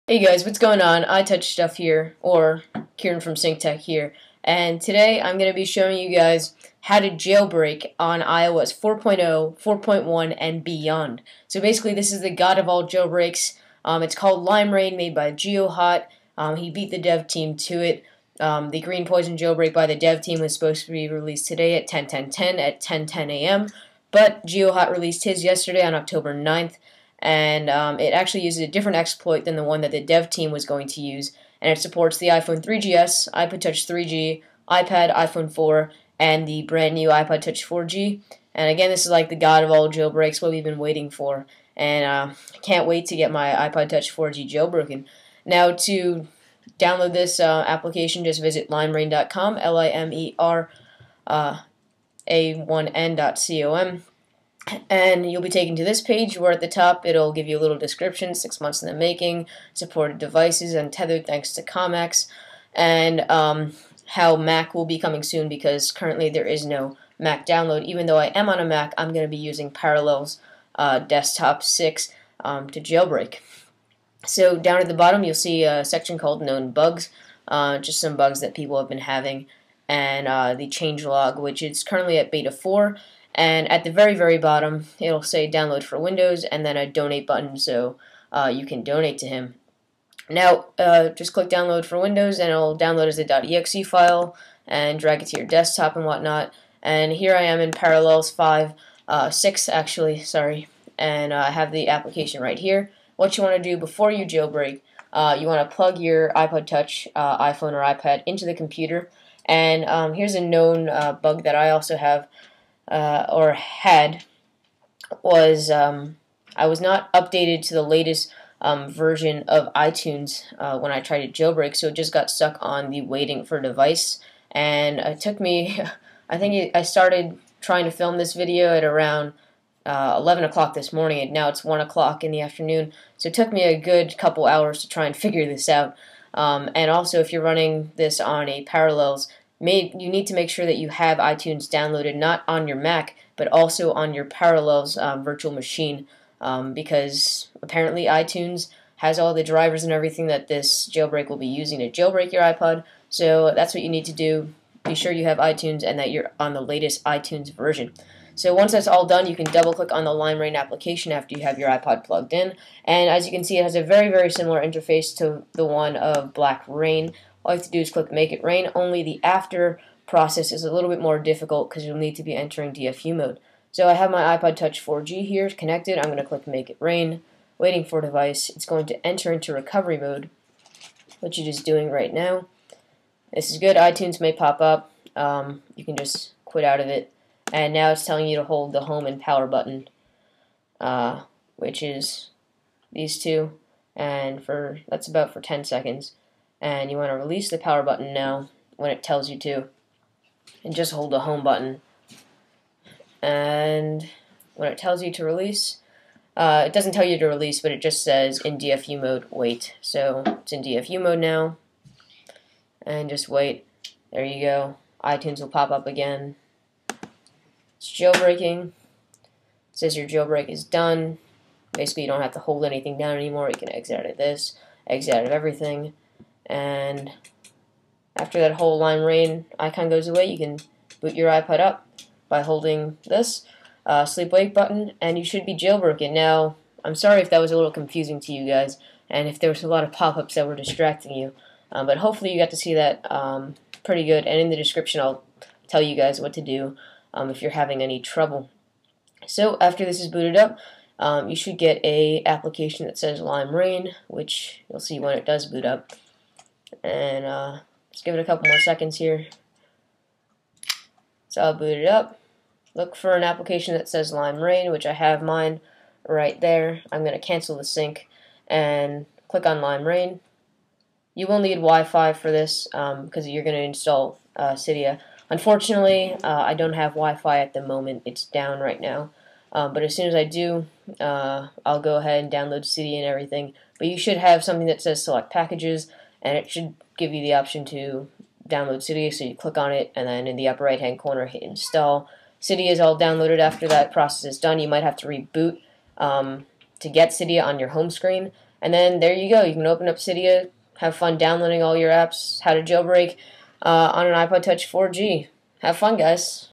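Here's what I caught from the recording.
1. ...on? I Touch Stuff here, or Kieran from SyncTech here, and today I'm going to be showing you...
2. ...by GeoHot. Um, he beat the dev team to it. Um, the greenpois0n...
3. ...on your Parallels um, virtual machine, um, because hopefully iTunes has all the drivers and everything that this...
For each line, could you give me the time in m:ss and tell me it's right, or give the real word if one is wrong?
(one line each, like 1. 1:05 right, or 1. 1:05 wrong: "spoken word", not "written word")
1. 0:00 right
2. 0:15 right
3. 2:23 wrong: "apparently", not "hopefully".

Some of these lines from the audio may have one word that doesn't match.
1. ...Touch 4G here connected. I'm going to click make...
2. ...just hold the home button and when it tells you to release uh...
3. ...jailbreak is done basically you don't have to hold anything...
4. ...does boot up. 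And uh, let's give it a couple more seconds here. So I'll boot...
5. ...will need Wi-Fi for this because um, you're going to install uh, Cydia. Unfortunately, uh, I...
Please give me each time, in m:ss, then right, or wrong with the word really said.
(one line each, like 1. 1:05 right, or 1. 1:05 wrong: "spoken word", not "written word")
1. 2:54 right
2. 3:20 right
3. 3:40 right
4. 4:15 right
5. 4:31 right.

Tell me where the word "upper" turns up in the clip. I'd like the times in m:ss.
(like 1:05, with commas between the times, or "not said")
4:50.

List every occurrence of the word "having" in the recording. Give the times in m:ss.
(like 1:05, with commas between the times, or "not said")
1:18, 4:07.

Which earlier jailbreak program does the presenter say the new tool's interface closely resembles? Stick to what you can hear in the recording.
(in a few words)
blackra1n.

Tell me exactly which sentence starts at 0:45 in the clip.
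Now to download this uh, application, just visit limerain.com, L-I-M-E-R.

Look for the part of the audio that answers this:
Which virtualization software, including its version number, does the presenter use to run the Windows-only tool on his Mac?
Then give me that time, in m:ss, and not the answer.
1:09.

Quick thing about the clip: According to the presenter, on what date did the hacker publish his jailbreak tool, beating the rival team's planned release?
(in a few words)
October 9th.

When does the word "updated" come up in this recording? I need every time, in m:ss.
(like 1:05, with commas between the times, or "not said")
1:57.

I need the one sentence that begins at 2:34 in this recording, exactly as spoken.
Be sure you have iTunes and that you're on the latest iTunes version.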